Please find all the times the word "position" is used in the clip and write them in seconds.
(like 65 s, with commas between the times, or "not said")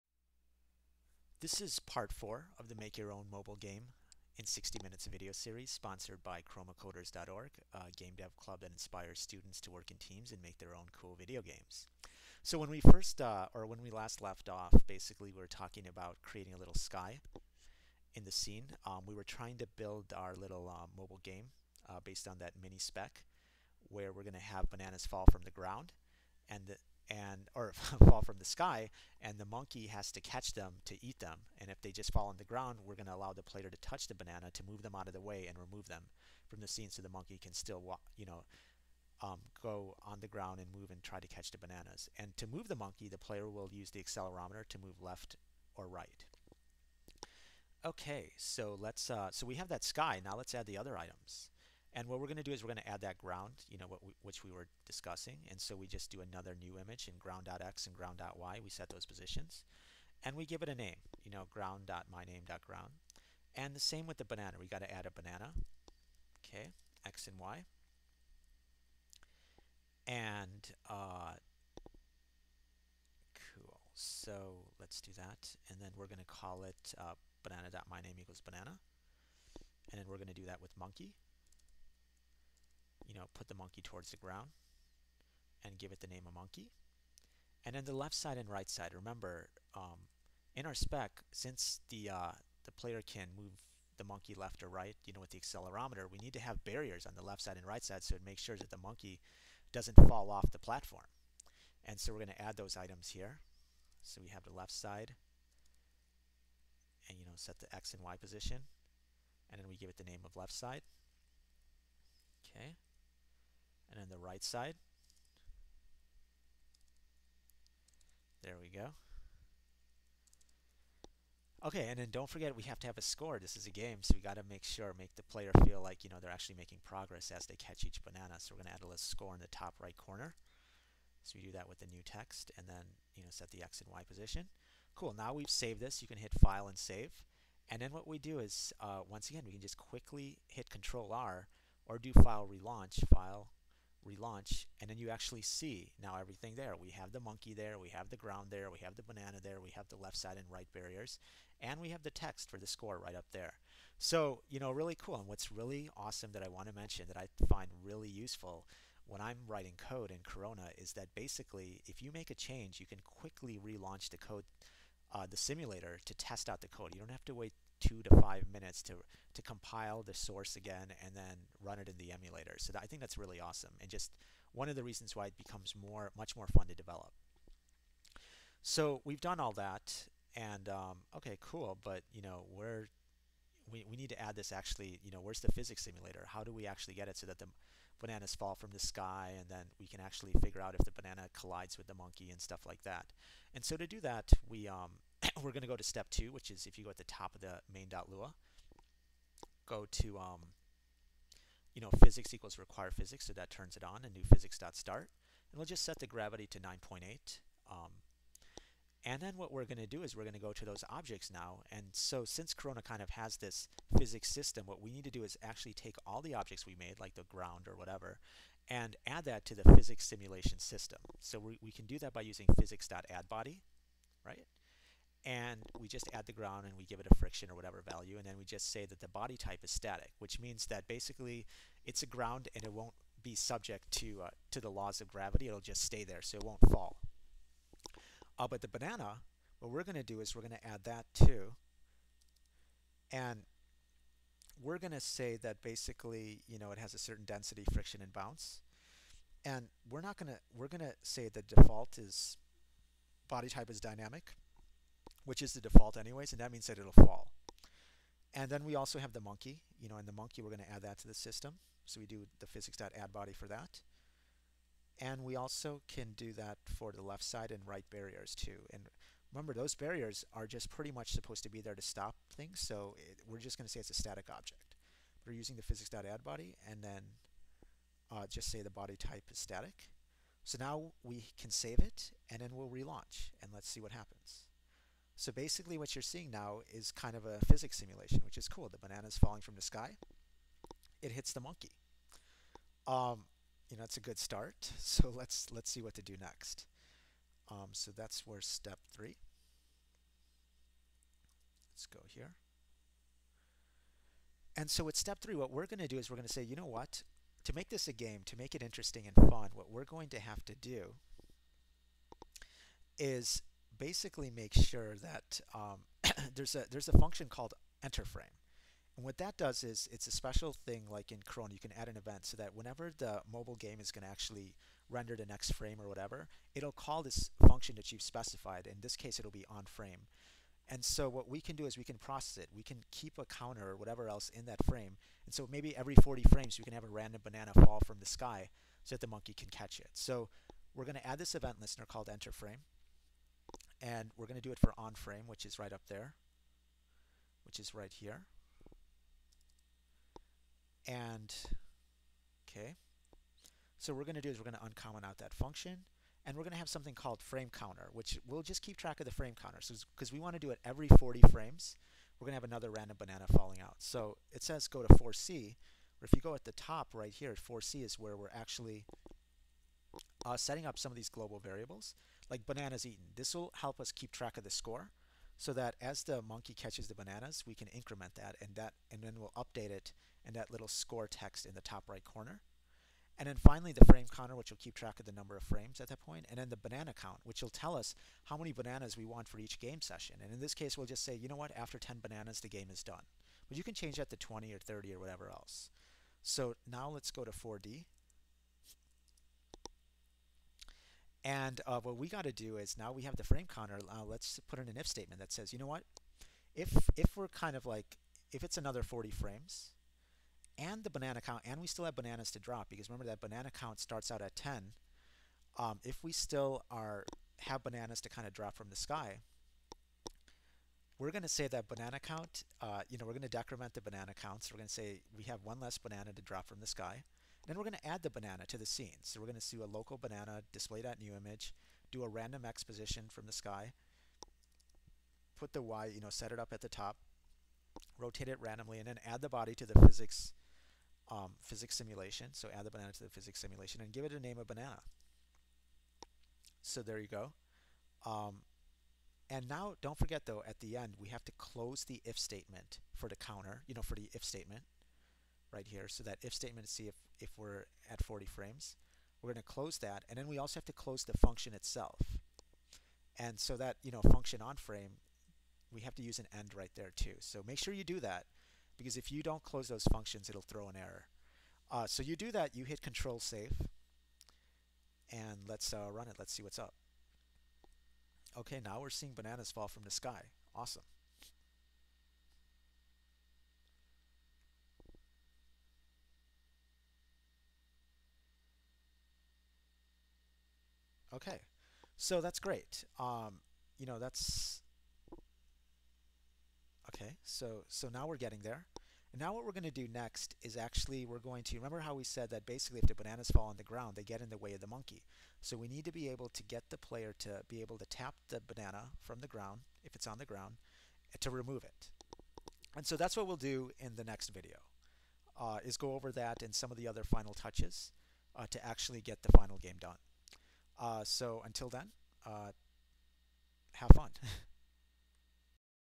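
59 s, 108 s, 134 s, 432 s.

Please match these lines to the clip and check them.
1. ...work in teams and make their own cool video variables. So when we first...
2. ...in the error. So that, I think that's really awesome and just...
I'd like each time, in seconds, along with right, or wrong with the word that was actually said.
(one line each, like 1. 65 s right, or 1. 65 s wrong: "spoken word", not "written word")
1. 9 s wrong: "games", not "variables"
2. 171 s wrong: "emulator", not "error".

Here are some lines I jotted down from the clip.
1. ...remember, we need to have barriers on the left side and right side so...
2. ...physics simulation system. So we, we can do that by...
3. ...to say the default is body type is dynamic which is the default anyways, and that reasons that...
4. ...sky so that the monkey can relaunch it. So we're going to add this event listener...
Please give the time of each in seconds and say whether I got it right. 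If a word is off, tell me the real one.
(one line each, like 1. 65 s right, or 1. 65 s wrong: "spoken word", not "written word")
1. 95 s wrong: "accelerometer", not "remember"
2. 219 s right
3. 250 s wrong: "means", not "reasons"
4. 338 s wrong: "catch", not "relaunch".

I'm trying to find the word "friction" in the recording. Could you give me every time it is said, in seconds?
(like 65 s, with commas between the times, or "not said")
227 s, 247 s.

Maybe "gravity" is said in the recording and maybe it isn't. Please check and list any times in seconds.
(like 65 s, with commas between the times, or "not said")
206 s, 235 s.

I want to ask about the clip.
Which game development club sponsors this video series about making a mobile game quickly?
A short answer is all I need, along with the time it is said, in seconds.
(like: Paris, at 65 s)
chromacoders.org, at 6 s.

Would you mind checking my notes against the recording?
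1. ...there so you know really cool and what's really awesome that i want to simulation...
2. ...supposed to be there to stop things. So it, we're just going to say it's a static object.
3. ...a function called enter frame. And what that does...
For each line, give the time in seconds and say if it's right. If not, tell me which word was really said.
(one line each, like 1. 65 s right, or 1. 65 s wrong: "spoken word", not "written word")
1. 153 s wrong: "mention", not "simulation"
2. 271 s right
3. 316 s right.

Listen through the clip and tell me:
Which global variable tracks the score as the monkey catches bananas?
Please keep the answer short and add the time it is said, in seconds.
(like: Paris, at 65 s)
bananas eaten, at 372 s.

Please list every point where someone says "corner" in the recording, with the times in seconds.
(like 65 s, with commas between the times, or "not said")
129 s, 382 s.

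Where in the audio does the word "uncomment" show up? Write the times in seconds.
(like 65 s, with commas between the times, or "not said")
354 s.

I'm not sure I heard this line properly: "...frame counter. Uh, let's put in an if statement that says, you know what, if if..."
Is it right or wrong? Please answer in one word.
right.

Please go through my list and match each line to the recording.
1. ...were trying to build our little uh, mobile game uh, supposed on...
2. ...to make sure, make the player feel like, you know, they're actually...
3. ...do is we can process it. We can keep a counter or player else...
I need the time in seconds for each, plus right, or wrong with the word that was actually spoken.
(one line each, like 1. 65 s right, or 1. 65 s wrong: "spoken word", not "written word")
1. 19 s wrong: "based", not "supposed"
2. 124 s right
3. 331 s wrong: "whatever", not "player".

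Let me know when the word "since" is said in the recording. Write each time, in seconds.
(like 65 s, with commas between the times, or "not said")
91 s, 212 s.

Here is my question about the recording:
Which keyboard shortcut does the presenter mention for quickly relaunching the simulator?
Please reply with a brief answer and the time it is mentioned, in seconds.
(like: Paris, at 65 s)
Control R, at 140 s.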